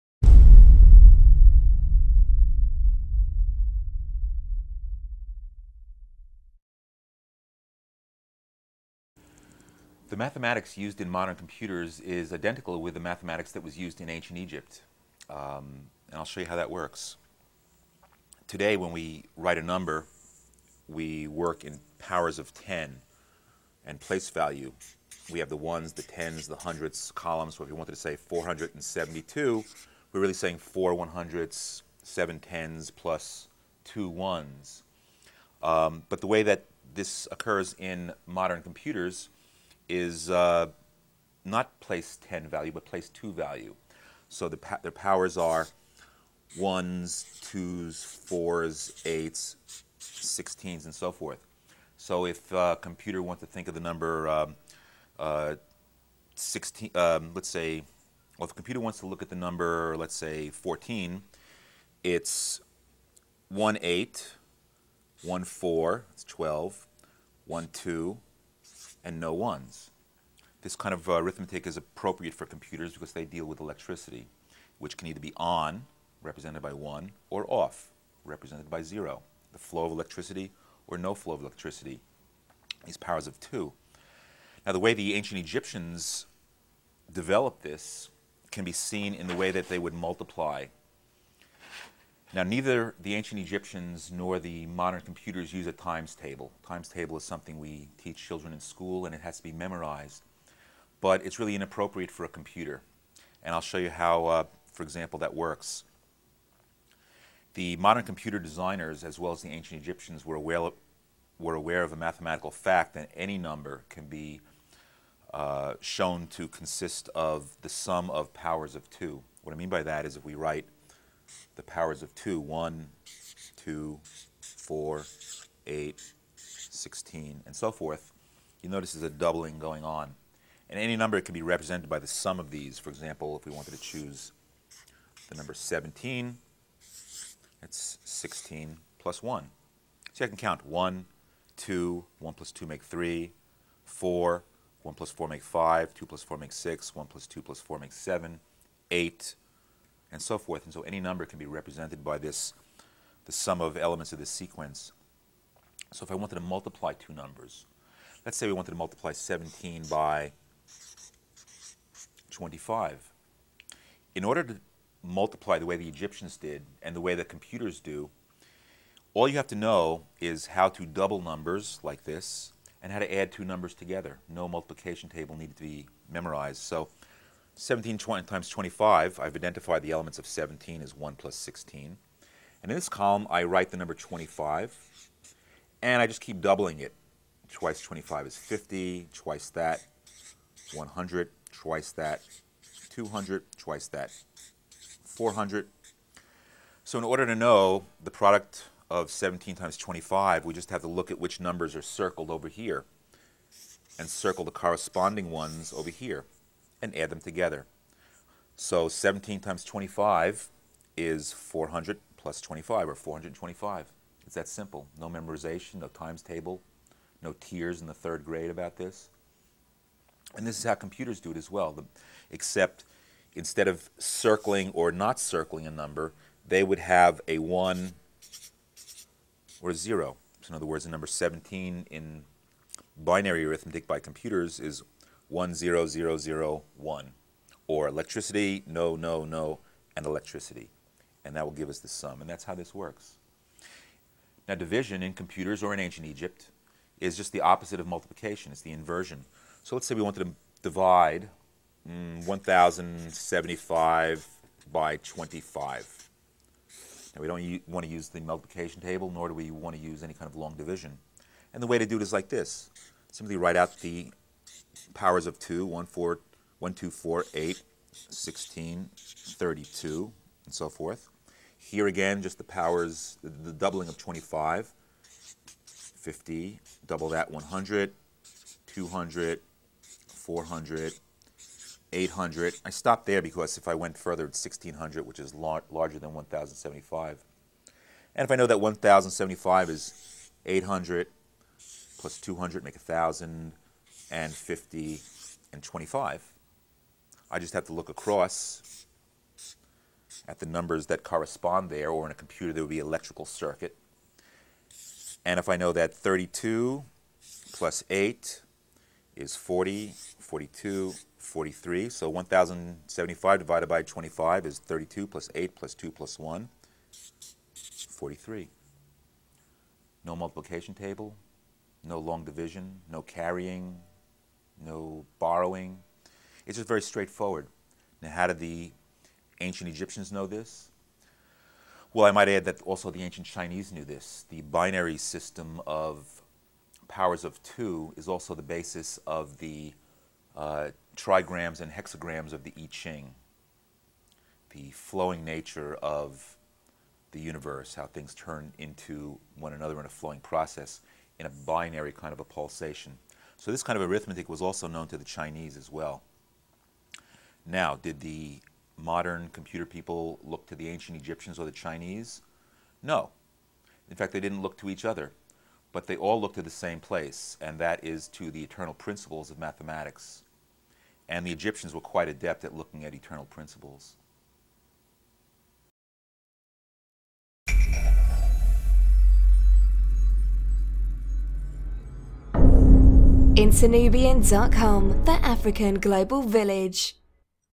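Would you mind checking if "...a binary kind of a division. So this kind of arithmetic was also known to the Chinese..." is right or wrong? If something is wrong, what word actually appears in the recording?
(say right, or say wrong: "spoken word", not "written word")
wrong: "pulsation", not "division".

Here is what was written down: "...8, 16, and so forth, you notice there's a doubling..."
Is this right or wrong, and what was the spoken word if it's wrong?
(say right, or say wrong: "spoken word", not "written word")
right.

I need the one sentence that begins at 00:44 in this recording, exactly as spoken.
So the their powers are 1s, 2s, 4s, 8s, 16s, and so forth.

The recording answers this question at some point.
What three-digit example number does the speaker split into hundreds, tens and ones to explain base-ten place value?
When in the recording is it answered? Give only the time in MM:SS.
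00:28.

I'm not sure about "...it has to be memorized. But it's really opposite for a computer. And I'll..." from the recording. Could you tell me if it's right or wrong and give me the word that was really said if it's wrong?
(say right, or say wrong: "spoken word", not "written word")
wrong: "inappropriate", not "opposite".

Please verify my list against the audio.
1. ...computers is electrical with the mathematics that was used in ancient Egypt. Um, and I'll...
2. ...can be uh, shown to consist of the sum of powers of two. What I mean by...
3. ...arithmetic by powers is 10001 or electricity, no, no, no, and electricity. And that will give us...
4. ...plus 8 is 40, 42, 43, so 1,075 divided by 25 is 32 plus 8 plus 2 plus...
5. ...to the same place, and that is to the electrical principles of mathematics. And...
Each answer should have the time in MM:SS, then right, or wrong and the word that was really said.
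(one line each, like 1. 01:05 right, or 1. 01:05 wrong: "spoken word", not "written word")
1. 00:11 wrong: "identical", not "electrical"
2. 01:53 right
3. 03:53 wrong: "computers", not "powers"
4. 05:07 right
5. 06:06 wrong: "eternal", not "electrical".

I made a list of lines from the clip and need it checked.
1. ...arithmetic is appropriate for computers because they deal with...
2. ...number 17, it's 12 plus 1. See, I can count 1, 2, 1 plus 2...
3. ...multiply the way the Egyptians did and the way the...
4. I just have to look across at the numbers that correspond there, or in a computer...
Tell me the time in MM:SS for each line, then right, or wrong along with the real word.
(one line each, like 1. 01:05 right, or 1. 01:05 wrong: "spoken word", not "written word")
1. 01:11 right
2. 02:15 wrong: "16", not "12"
3. 02:45 right
4. 04:57 right.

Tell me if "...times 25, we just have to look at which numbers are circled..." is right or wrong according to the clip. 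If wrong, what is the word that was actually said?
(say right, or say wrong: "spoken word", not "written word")
right.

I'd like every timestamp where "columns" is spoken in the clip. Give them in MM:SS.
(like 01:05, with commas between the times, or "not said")
00:27, 03:02.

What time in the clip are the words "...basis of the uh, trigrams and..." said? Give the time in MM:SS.
05:38.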